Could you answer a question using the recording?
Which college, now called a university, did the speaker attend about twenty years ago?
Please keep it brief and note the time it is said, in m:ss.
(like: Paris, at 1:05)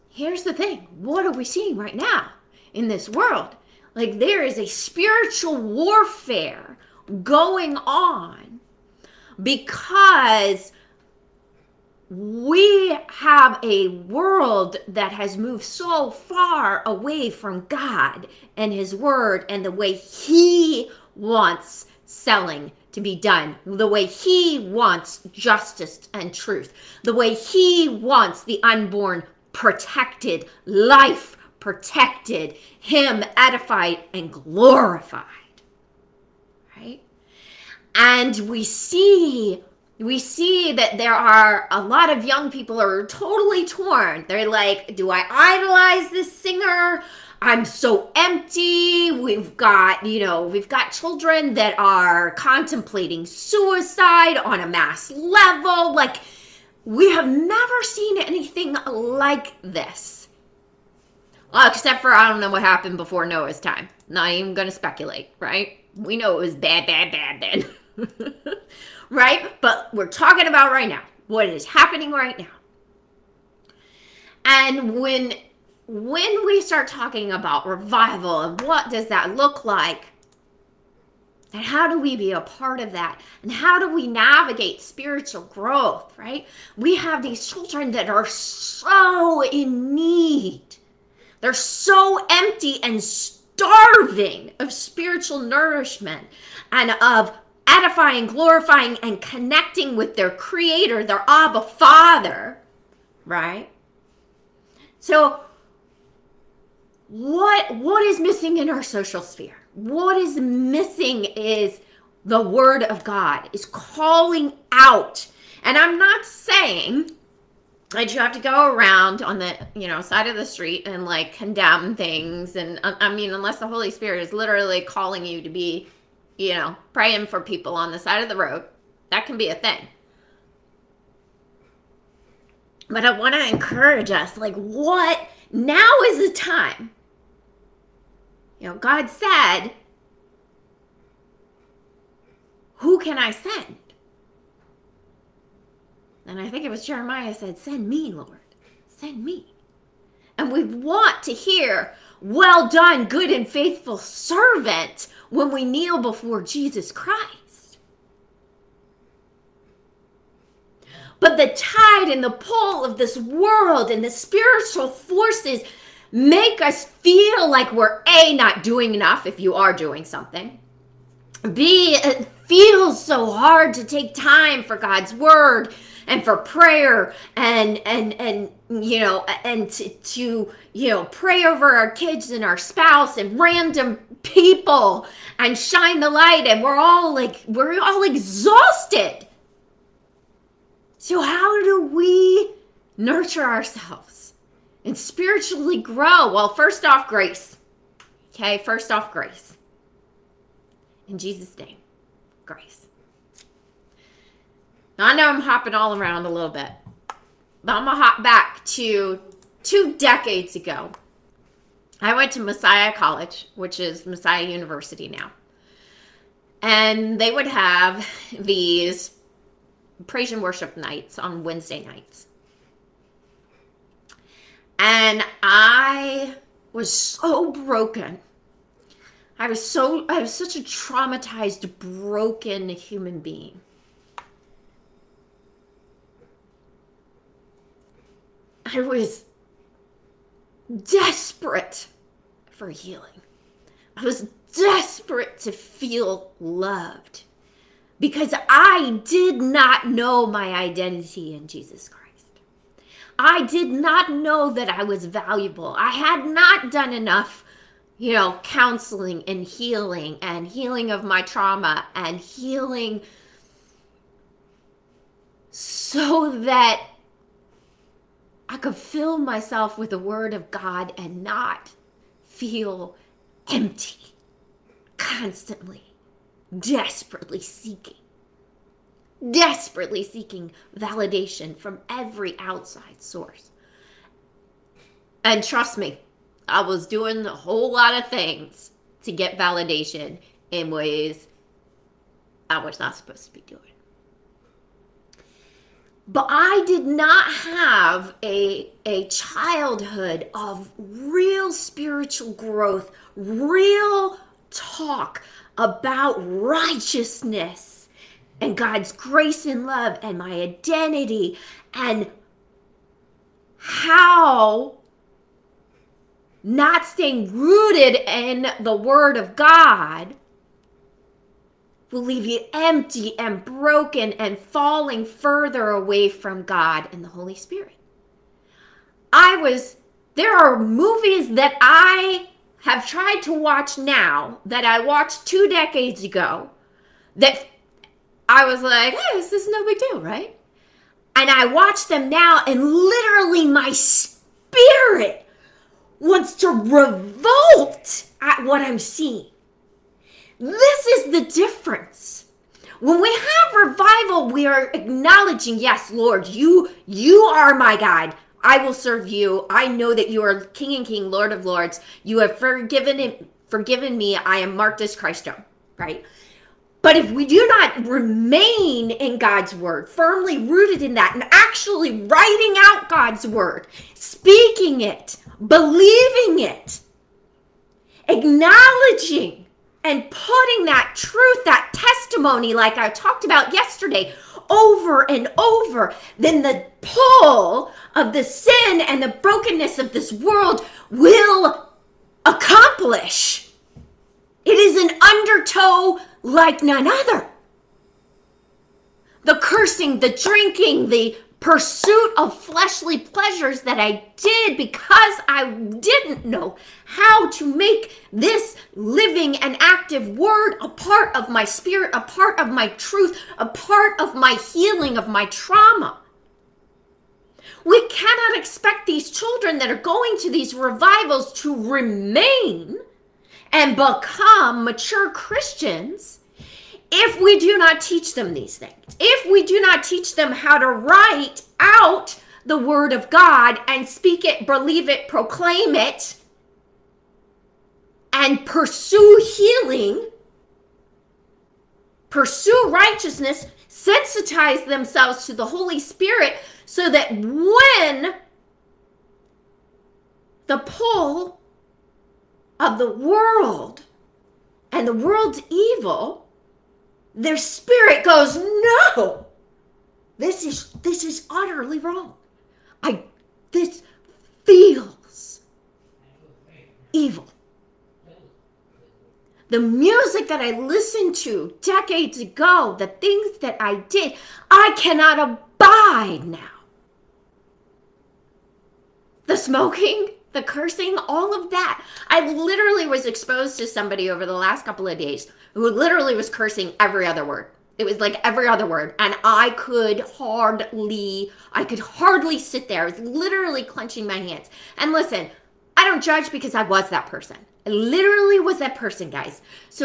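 Messiah College, at 3:32.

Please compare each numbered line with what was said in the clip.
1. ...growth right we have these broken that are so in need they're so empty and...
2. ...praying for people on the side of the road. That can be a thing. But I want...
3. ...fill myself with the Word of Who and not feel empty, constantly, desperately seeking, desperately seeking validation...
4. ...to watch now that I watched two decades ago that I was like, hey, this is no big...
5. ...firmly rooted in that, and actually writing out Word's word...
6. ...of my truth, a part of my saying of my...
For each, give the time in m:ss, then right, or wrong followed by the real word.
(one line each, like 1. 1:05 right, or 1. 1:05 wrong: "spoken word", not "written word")
1. 1:25 wrong: "children", not "broken"
2. 2:06 right
3. 4:28 wrong: "God", not "Who"
4. 5:33 right
5. 6:09 wrong: "God", not "Word"
6. 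6:52 wrong: "healing", not "saying".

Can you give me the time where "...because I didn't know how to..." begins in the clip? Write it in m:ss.
6:44.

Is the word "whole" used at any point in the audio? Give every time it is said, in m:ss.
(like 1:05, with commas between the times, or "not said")
4:47.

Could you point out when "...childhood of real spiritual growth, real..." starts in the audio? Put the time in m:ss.
4:59.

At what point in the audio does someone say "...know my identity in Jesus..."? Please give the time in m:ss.
4:09.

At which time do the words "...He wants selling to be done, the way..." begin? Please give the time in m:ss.
0:19.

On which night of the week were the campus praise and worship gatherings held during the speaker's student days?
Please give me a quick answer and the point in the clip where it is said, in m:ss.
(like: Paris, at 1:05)
Wednesday, at 3:41.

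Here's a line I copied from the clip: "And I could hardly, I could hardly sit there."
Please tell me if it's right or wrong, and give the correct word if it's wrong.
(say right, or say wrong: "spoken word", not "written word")
right.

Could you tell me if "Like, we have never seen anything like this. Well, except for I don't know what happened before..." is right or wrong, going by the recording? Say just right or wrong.
right.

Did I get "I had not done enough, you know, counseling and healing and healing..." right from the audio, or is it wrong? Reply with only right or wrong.
right.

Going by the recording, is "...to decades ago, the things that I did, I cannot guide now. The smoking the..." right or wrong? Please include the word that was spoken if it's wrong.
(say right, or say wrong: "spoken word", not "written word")
wrong: "abide", not "guide".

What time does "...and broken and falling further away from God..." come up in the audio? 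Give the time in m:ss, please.
5:23.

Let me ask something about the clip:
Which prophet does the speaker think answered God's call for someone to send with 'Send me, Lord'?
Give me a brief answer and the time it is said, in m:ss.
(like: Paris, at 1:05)
Jeremiah, at 2:26.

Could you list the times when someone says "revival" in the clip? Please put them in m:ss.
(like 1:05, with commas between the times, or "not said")
1:17, 5:53, 7:00.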